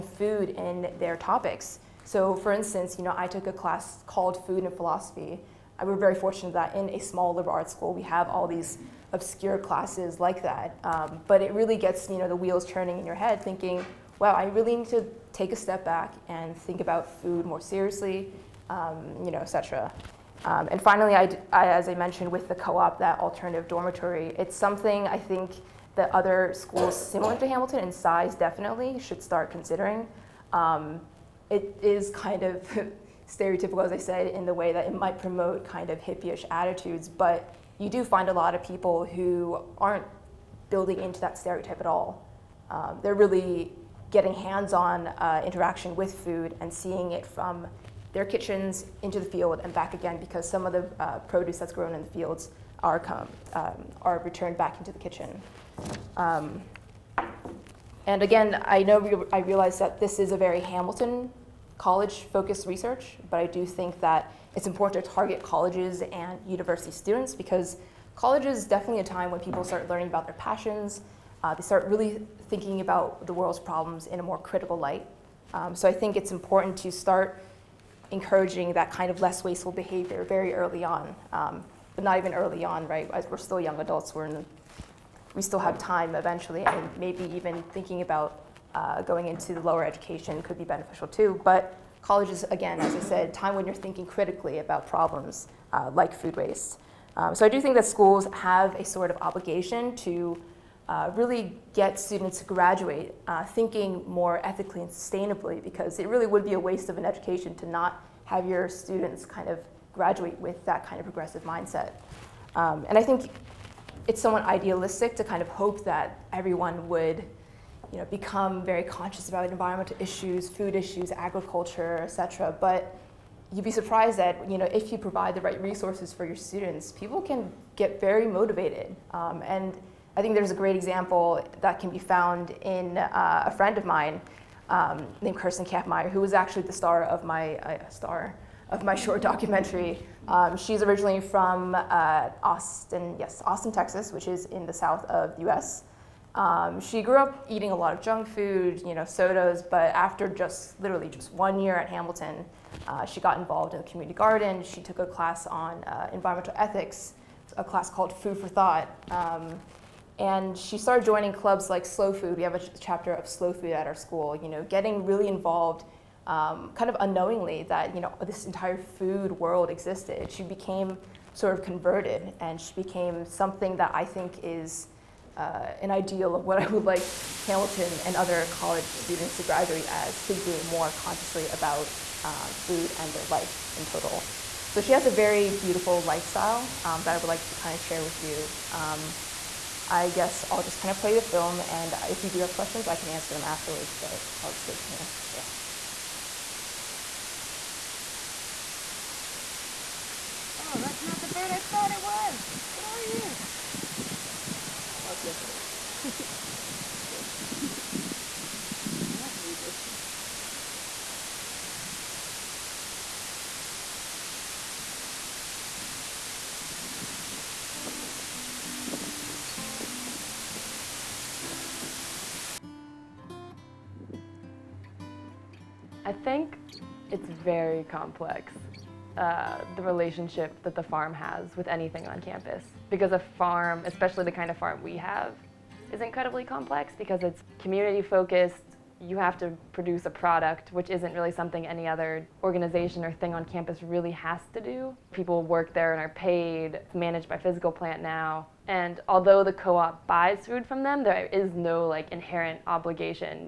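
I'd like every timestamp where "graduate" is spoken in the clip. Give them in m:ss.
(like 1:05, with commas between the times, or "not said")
1:42, 1:49, 2:59.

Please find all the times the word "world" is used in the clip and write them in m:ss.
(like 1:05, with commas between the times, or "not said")
1:13, 2:49.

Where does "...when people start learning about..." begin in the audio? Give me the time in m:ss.
1:09.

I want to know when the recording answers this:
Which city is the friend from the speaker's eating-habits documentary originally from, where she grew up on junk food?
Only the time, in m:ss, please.
2:23.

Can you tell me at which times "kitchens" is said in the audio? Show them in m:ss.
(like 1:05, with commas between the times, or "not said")
0:48, 0:54.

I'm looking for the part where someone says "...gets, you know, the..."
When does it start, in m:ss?
0:11.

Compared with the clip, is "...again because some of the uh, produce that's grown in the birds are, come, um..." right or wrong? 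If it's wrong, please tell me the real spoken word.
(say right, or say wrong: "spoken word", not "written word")
wrong: "fields", not "birds".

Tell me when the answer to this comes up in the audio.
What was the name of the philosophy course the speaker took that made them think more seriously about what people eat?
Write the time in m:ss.
0:04.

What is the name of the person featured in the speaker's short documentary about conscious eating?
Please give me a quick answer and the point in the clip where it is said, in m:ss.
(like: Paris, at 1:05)
Kirsten Kampmeyer, at 2:15.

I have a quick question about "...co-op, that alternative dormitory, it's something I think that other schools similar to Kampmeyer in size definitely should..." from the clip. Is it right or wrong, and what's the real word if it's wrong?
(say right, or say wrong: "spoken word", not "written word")
wrong: "Hamilton", not "Kampmeyer".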